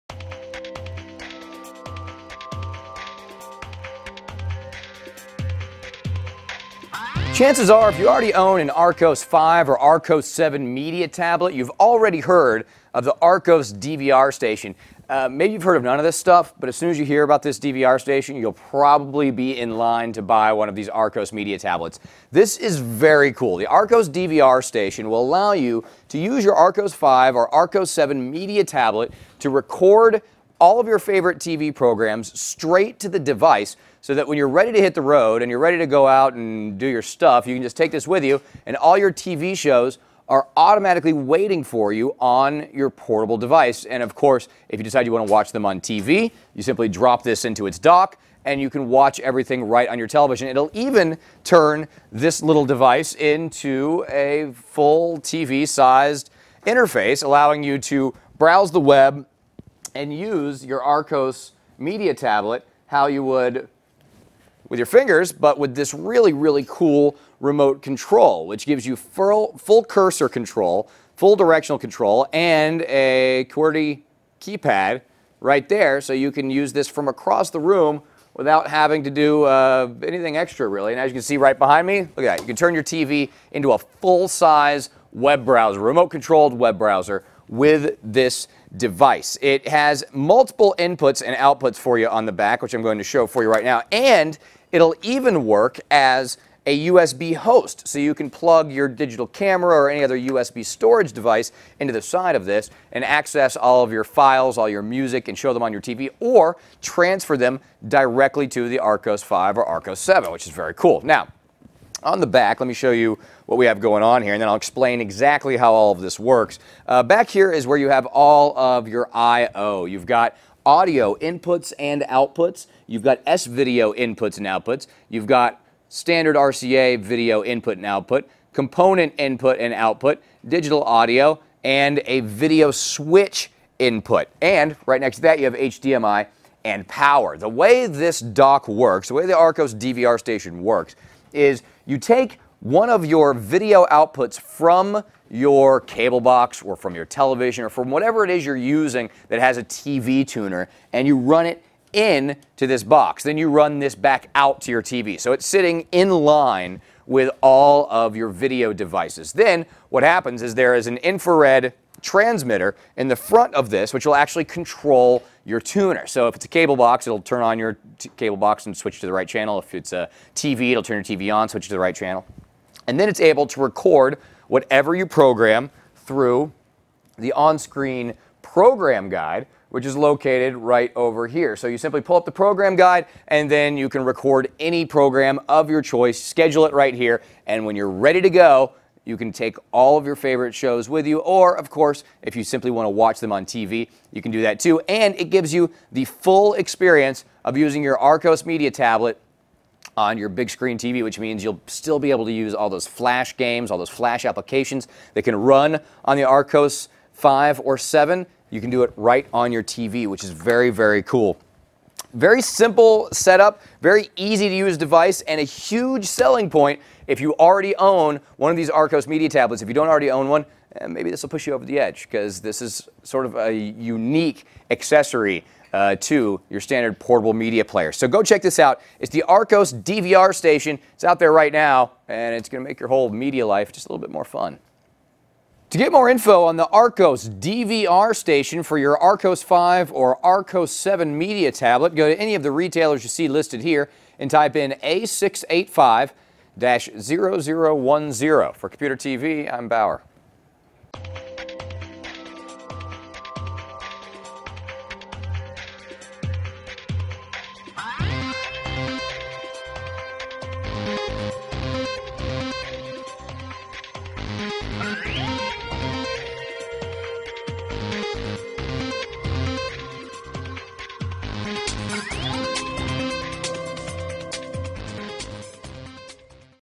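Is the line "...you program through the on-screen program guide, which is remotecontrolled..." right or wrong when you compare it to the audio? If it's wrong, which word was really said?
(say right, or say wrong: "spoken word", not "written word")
wrong: "located", not "remotecontrolled".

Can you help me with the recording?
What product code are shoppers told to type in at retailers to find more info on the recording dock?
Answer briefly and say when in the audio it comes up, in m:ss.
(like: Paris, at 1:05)
A685-0010, at 4:04.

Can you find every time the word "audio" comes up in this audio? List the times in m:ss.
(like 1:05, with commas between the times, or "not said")
2:00, 2:10.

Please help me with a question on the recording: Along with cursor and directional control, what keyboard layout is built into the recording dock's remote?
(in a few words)
QWERTY keypad.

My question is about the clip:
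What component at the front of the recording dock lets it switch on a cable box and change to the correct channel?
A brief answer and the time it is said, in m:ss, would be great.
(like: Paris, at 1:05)
infrared transmitter, at 2:40.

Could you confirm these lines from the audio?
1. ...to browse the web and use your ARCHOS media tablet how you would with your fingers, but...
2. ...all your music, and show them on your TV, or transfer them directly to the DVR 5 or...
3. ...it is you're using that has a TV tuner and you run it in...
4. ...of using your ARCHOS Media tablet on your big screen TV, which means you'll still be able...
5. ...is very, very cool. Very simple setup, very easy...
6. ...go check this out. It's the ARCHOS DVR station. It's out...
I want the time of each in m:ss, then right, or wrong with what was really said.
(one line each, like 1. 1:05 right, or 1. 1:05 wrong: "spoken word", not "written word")
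1. 0:57 right
2. 1:44 wrong: "ARCHOS", not "DVR"
3. 2:28 right
4. 3:17 right
5. 3:30 right
6. 3:48 right.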